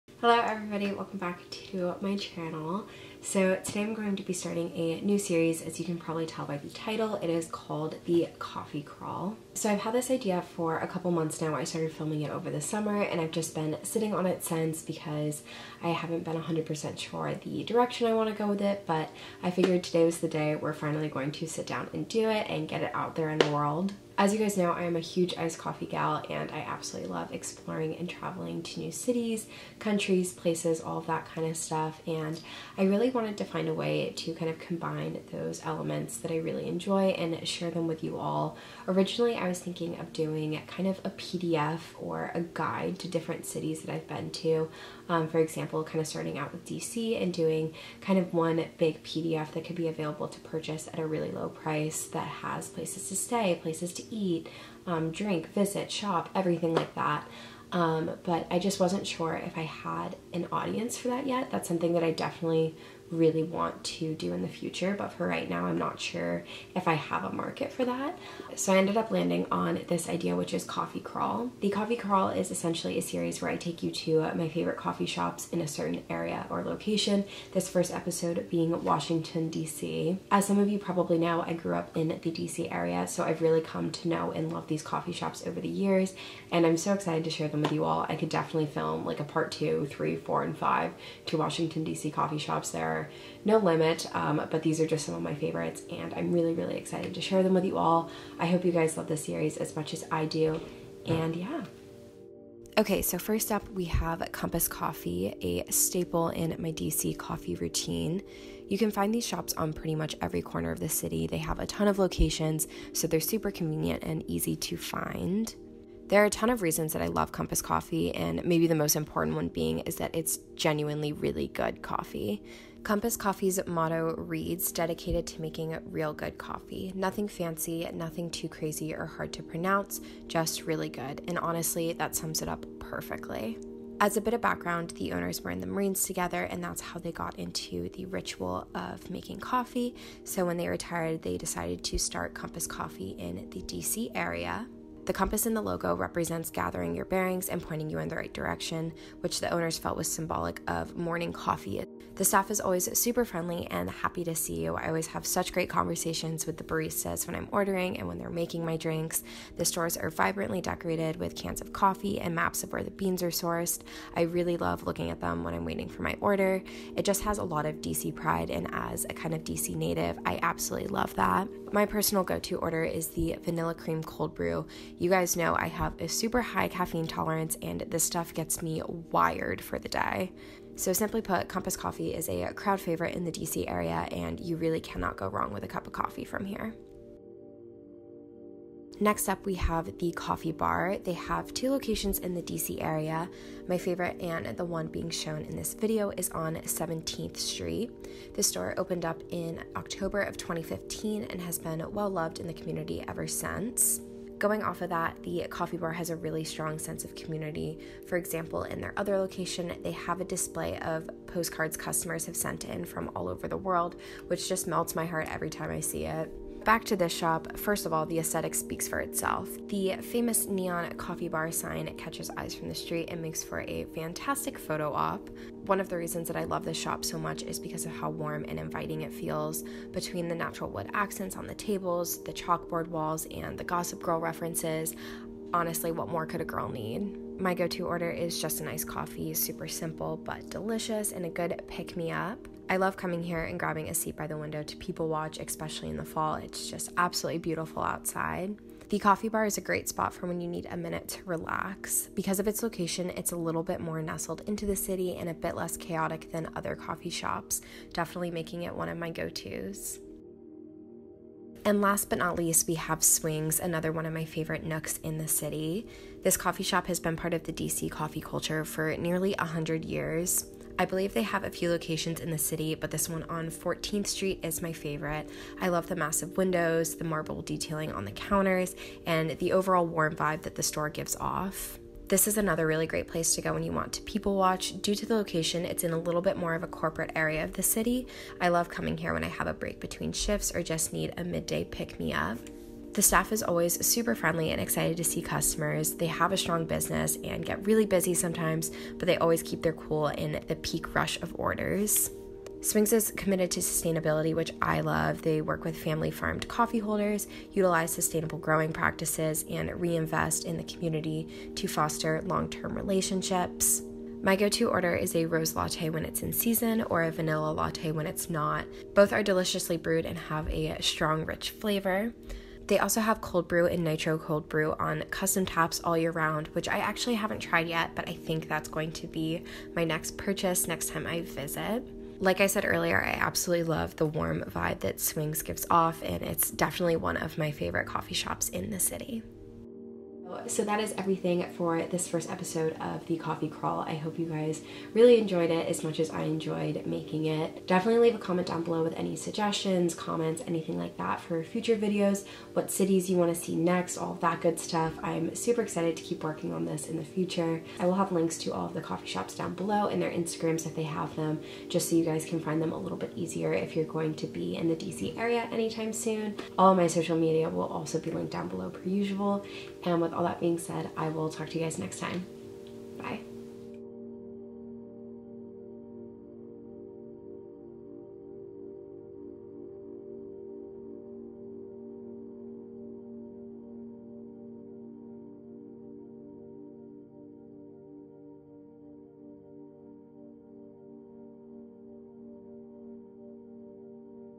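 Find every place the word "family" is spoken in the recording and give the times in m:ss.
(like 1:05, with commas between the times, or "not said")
5:05.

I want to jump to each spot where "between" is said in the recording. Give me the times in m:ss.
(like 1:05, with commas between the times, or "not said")
3:49, 4:49.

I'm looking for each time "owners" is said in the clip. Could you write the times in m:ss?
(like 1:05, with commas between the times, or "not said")
2:15, 2:29.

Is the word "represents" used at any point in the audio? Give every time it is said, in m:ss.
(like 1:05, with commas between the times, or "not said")
2:25.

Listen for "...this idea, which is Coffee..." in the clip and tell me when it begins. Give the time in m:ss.
1:09.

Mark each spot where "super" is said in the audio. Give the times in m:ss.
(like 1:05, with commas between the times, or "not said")
1:53, 2:32, 2:56, 3:59, 4:53, 5:55.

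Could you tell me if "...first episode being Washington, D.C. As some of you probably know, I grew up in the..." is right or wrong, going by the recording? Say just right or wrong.
right.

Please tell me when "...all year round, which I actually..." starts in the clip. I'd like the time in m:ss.
5:25.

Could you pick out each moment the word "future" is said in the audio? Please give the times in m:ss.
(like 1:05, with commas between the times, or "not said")
1:04, 5:51, 5:57.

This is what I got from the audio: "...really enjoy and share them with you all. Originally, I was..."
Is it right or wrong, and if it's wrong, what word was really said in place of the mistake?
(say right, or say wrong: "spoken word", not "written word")
right.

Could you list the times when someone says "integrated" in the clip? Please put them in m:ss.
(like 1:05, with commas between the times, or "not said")
not said.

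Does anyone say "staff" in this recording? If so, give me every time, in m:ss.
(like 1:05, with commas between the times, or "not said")
2:32, 4:53.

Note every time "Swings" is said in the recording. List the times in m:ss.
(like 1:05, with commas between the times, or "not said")
4:23, 5:02, 5:35.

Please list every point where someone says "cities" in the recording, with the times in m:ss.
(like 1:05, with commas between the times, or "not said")
0:28, 0:43, 5:52.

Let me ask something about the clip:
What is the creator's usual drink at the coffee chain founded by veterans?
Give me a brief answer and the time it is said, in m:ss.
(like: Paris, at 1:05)
Vanilla cream cold brew, at 2:53.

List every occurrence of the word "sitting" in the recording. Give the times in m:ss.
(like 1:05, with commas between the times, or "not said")
0:13.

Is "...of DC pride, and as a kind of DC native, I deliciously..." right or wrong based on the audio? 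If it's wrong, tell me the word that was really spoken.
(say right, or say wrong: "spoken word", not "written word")
wrong: "absolutely", not "deliciously".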